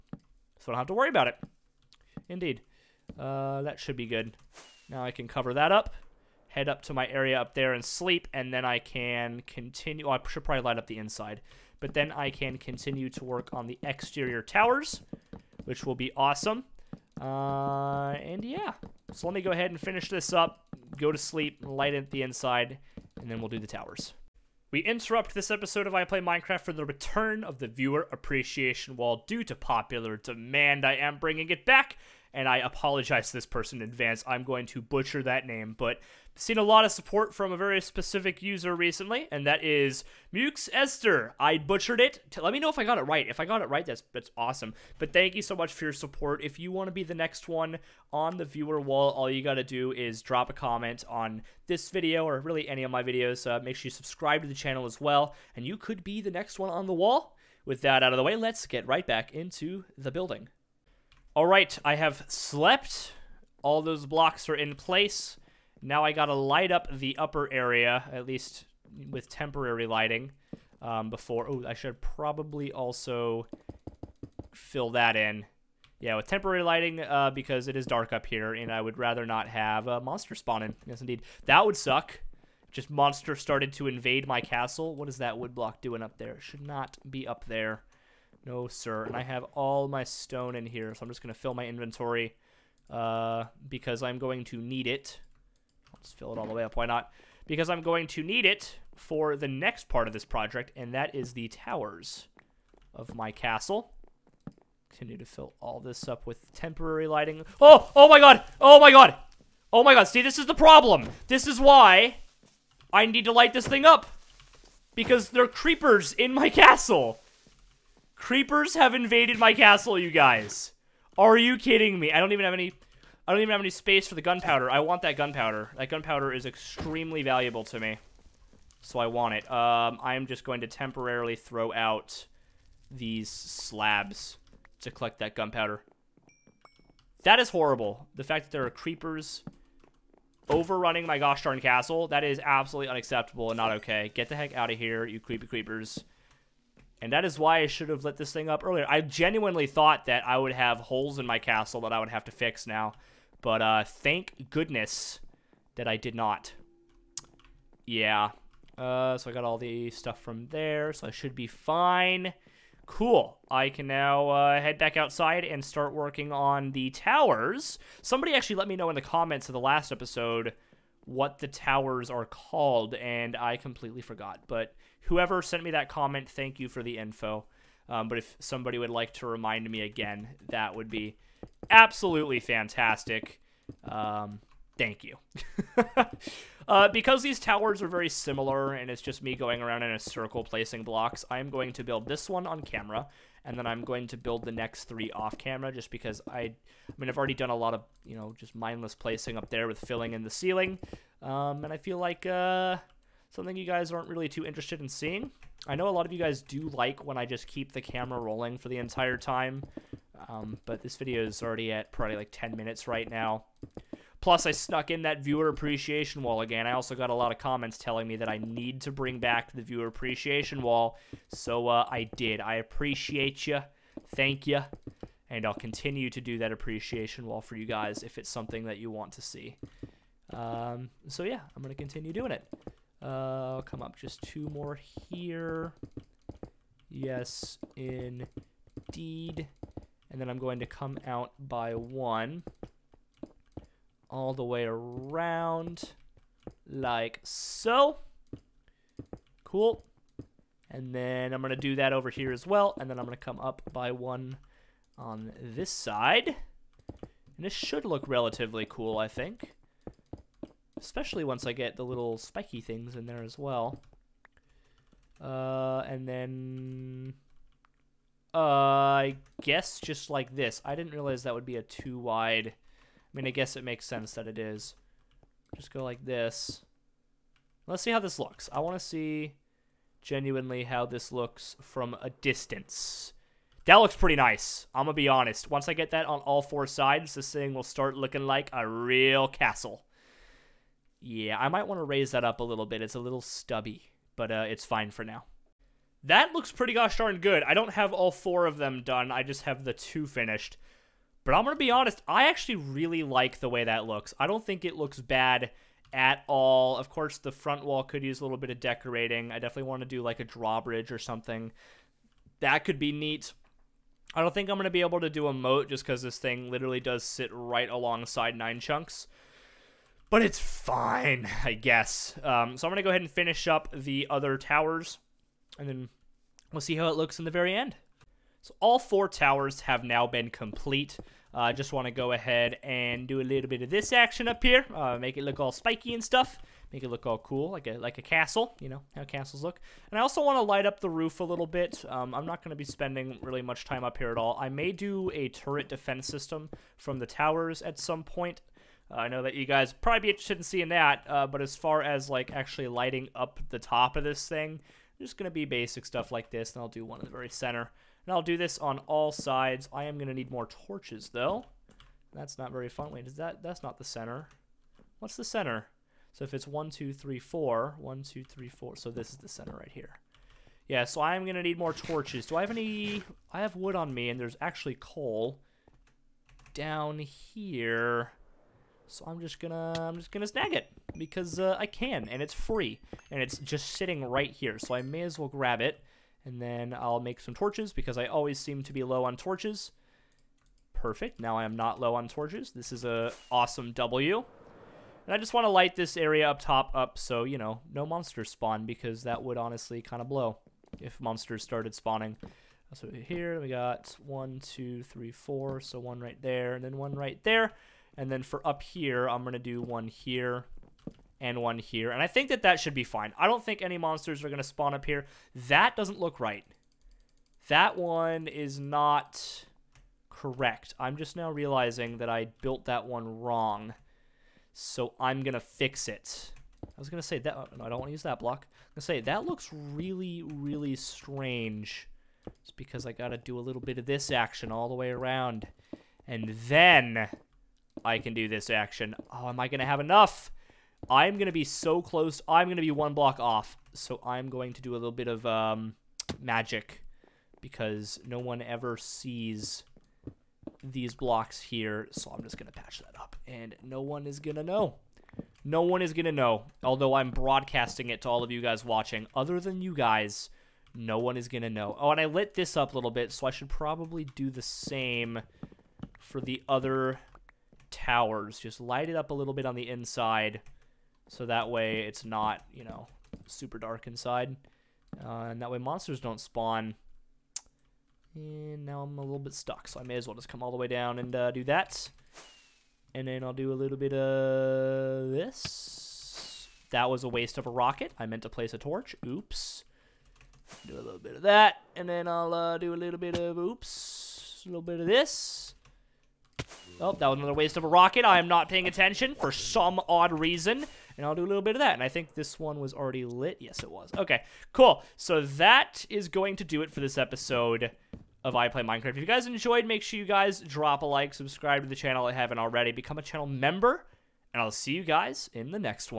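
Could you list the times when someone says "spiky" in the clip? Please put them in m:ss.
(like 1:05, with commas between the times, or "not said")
4:22, 5:35.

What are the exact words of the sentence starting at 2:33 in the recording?
But uh, thank goodness that I did not.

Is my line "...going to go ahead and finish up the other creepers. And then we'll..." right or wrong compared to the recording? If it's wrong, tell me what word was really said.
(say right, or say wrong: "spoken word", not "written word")
wrong: "towers", not "creepers".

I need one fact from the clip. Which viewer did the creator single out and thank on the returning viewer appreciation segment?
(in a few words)
Mux Esther.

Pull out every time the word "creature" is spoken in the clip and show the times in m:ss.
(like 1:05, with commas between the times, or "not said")
not said.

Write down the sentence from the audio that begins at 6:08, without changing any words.
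So this is the center right here.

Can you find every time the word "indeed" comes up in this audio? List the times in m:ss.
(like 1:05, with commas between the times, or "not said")
0:02, 1:20, 3:57.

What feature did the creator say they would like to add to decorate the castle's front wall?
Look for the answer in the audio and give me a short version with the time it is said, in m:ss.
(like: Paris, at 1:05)
A drawbridge, at 5:10.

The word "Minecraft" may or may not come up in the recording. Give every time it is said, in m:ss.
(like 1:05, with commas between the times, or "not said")
0:26, 8:28.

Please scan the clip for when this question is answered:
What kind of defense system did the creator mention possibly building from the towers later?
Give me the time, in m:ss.
5:45.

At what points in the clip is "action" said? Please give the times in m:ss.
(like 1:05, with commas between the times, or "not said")
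5:33, 7:14, 7:18.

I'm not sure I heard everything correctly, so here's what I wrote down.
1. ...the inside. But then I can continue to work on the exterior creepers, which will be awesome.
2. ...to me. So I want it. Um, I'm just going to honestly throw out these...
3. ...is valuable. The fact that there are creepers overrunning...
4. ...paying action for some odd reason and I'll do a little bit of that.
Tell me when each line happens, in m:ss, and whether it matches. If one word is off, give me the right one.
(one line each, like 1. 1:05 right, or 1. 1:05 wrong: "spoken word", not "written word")
1. 0:10 wrong: "towers", not "creepers"
2. 2:07 wrong: "temporarily", not "honestly"
3. 2:17 wrong: "horrible", not "valuable"
4. 8:18 wrong: "attention", not "action".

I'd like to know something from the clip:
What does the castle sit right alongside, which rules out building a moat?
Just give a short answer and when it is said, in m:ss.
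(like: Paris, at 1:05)
Nine Chunks, at 5:18.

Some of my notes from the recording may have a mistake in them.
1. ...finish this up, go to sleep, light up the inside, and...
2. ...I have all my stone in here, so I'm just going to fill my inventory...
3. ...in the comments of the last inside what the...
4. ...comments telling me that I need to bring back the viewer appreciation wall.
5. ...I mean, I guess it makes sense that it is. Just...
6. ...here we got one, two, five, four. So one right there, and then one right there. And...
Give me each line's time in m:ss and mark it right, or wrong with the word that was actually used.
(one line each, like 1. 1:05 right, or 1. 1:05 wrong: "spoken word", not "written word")
1. 0:19 right
2. 1:29 right
3. 2:48 wrong: "episode", not "inside"
4. 3:37 right
5. 4:33 right
6. 6:42 wrong: "three", not "five".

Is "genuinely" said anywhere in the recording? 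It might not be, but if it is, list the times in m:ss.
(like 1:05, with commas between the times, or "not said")
2:28, 4:39.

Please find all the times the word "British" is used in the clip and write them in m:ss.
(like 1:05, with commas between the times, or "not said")
not said.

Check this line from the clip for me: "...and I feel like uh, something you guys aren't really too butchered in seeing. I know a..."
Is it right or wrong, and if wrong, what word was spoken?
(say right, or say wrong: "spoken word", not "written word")
wrong: "interested", not "butchered".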